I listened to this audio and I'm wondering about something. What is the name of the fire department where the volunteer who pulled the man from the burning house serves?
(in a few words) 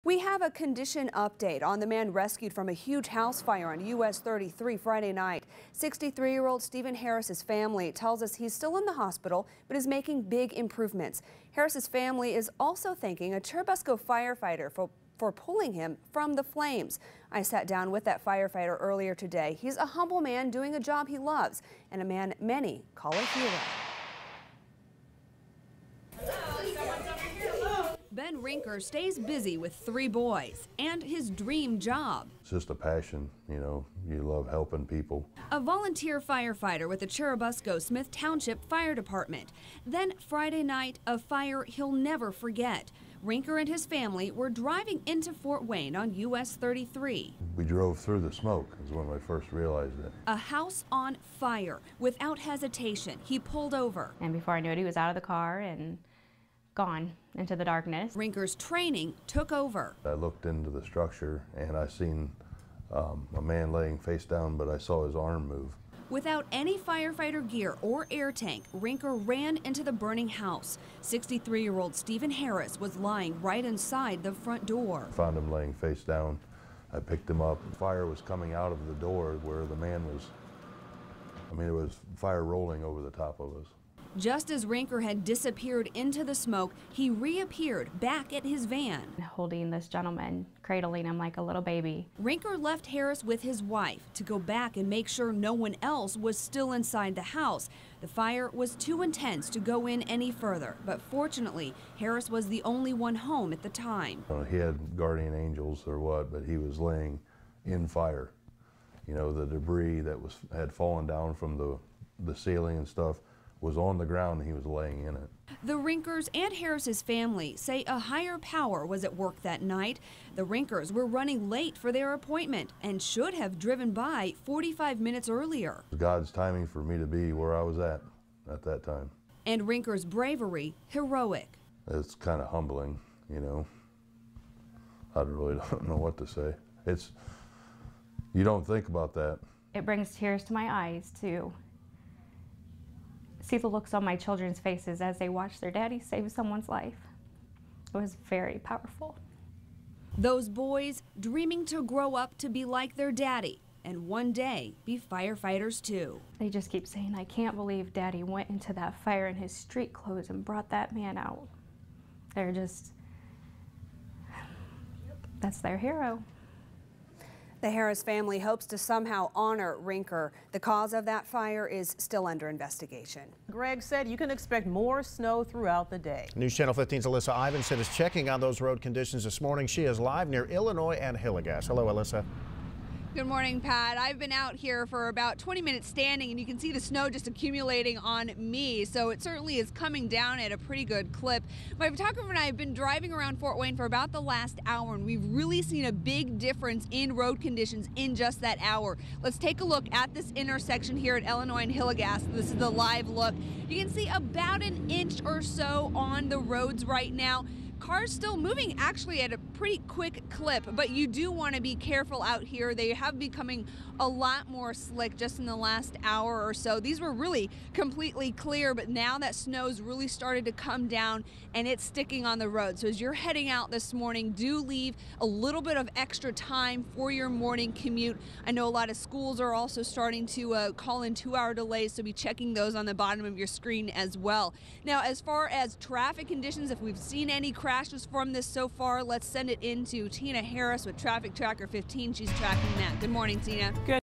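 Churubusco Smith Township Fire Department.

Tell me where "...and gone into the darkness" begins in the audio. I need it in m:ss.
0:55.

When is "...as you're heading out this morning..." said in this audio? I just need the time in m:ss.
3:42.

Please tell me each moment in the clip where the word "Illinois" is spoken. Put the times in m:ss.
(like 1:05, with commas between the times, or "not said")
3:00, 3:21.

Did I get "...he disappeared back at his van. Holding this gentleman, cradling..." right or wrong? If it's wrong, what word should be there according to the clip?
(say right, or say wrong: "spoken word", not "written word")
wrong: "reappeared", not "disappeared".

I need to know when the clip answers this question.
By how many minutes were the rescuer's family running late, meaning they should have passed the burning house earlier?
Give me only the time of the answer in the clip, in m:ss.
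2:04.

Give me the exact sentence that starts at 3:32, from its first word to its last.
They have becoming a lot more slick just in the last hour or so.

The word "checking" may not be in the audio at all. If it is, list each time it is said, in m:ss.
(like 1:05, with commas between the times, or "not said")
2:57, 3:52.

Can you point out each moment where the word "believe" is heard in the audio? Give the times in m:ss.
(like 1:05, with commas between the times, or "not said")
2:37.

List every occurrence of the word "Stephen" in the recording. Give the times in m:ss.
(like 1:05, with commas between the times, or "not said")
0:06, 1:11.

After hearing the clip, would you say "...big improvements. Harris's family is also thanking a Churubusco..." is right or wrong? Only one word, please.
right.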